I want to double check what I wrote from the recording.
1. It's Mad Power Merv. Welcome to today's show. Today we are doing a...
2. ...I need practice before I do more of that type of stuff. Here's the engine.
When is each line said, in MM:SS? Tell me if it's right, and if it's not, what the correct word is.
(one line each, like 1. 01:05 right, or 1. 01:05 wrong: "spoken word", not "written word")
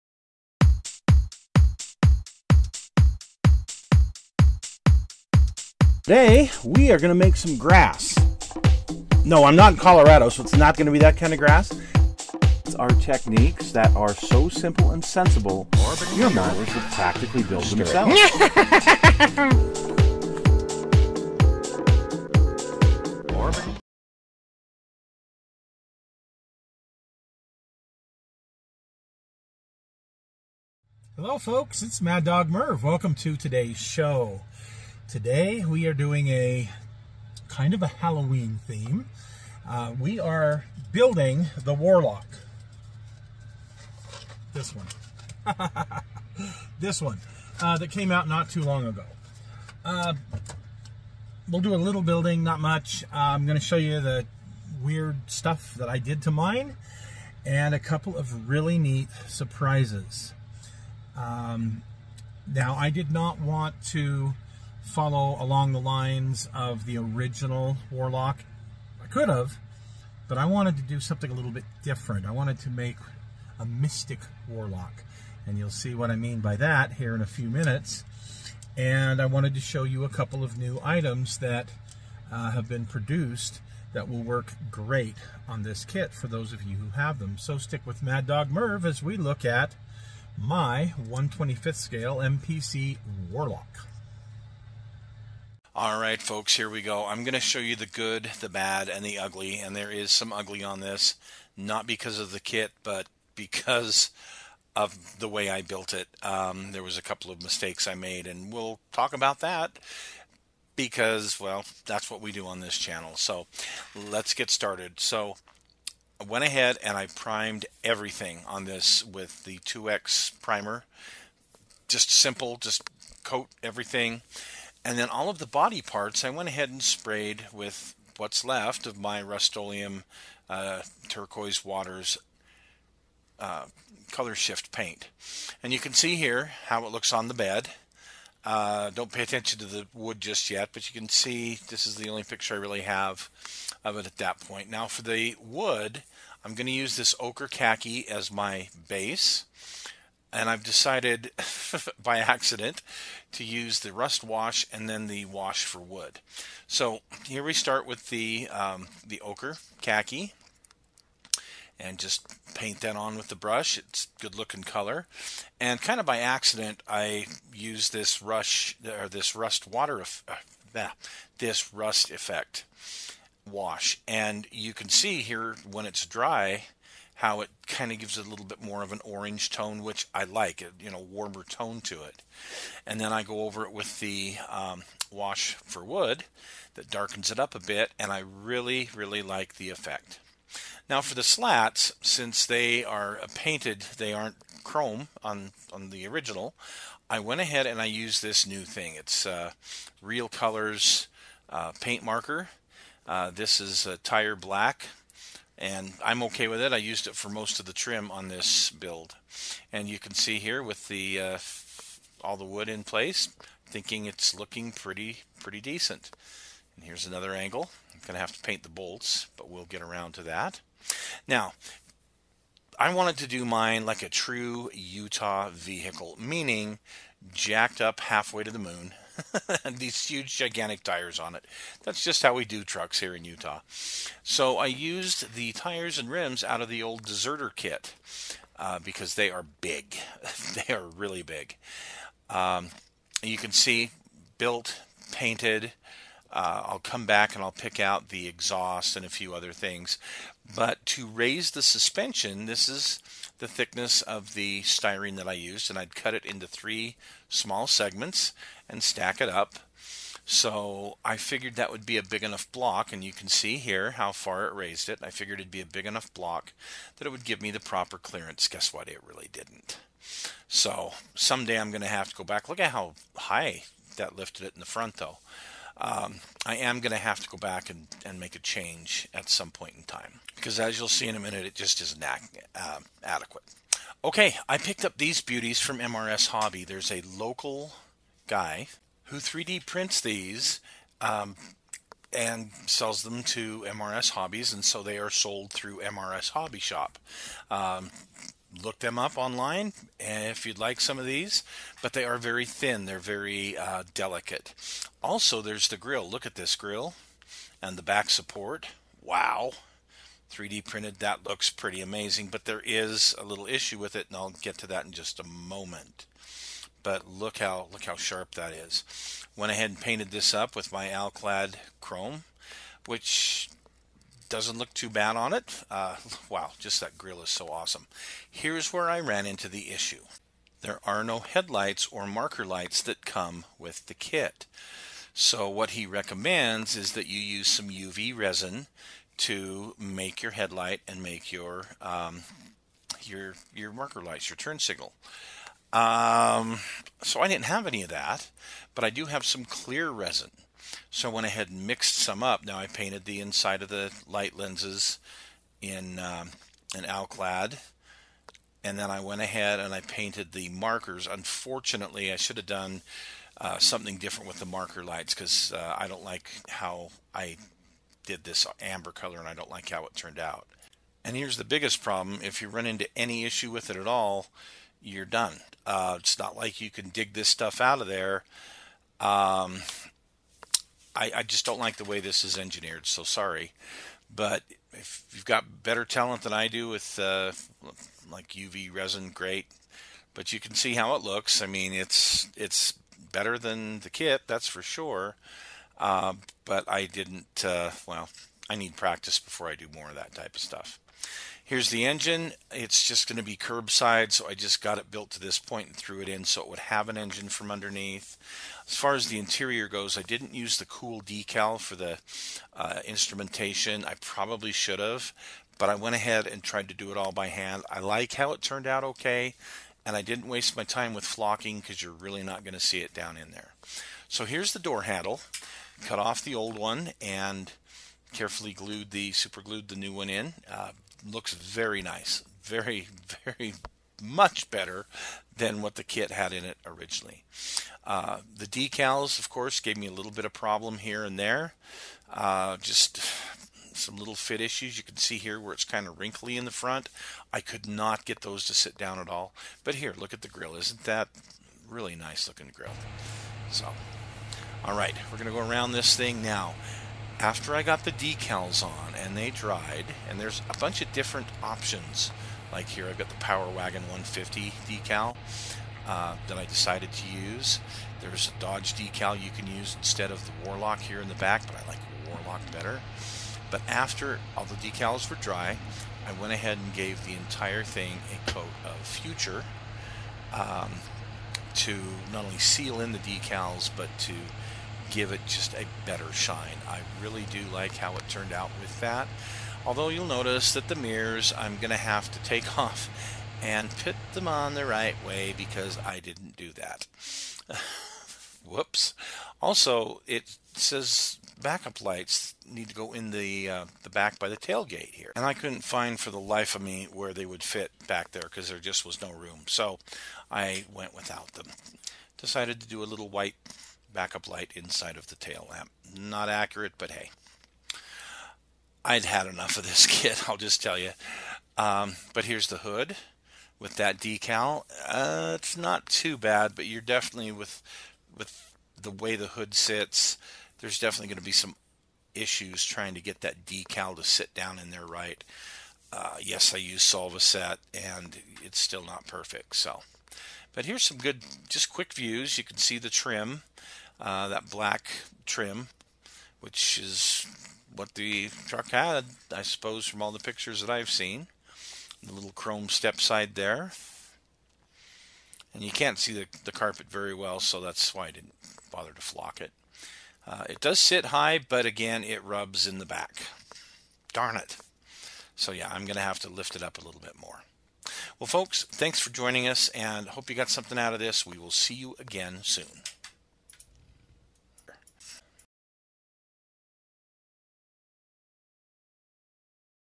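1. 00:31 wrong: "Dog", not "Power"
2. 06:38 right.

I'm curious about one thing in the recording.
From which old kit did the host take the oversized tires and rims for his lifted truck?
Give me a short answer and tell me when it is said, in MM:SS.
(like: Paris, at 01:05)
Deserter, at 03:57.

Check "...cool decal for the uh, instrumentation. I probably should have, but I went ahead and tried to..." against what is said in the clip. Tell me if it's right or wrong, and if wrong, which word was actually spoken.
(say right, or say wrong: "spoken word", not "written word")
right.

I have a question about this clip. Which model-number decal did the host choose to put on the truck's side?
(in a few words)
Power Wagon 150.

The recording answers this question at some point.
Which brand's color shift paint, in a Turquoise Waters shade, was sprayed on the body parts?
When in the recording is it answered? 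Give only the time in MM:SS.
02:09.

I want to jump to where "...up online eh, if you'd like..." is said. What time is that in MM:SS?
04:58.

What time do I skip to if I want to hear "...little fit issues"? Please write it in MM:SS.
07:23.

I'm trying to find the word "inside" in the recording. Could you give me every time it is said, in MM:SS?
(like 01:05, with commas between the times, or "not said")
05:53, 08:34.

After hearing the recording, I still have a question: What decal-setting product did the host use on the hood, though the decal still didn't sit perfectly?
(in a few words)
Solvaset.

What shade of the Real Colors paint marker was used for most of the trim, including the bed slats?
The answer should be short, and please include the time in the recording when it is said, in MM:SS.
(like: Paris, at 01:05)
Tire black, at 03:23.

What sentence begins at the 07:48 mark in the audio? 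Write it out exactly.
There's a Dodge decal you can use instead of the Warlock here in the back, but I like Warlock better.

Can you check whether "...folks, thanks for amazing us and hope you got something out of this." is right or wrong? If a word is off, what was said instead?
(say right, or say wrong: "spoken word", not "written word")
wrong: "joining", not "amazing".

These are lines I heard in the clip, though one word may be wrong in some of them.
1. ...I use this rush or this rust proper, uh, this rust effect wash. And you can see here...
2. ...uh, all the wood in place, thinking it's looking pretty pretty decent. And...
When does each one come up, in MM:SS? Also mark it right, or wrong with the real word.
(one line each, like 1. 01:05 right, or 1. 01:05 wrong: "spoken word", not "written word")
1. 02:46 wrong: "water", not "proper"
2. 03:31 right.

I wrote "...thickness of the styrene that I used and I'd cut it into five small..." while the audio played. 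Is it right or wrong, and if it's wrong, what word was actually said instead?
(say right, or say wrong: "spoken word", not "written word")
wrong: "three", not "five".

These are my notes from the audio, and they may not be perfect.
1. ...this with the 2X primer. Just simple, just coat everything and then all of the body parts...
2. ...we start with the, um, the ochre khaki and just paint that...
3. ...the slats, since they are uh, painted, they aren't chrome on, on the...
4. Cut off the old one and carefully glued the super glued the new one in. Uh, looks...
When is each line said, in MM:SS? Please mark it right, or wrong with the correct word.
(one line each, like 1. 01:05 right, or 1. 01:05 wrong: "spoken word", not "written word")
1. 01:58 right
2. 02:37 right
3. 03:11 right
4. 07:05 right.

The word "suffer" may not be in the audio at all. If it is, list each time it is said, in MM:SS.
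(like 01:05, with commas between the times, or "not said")
not said.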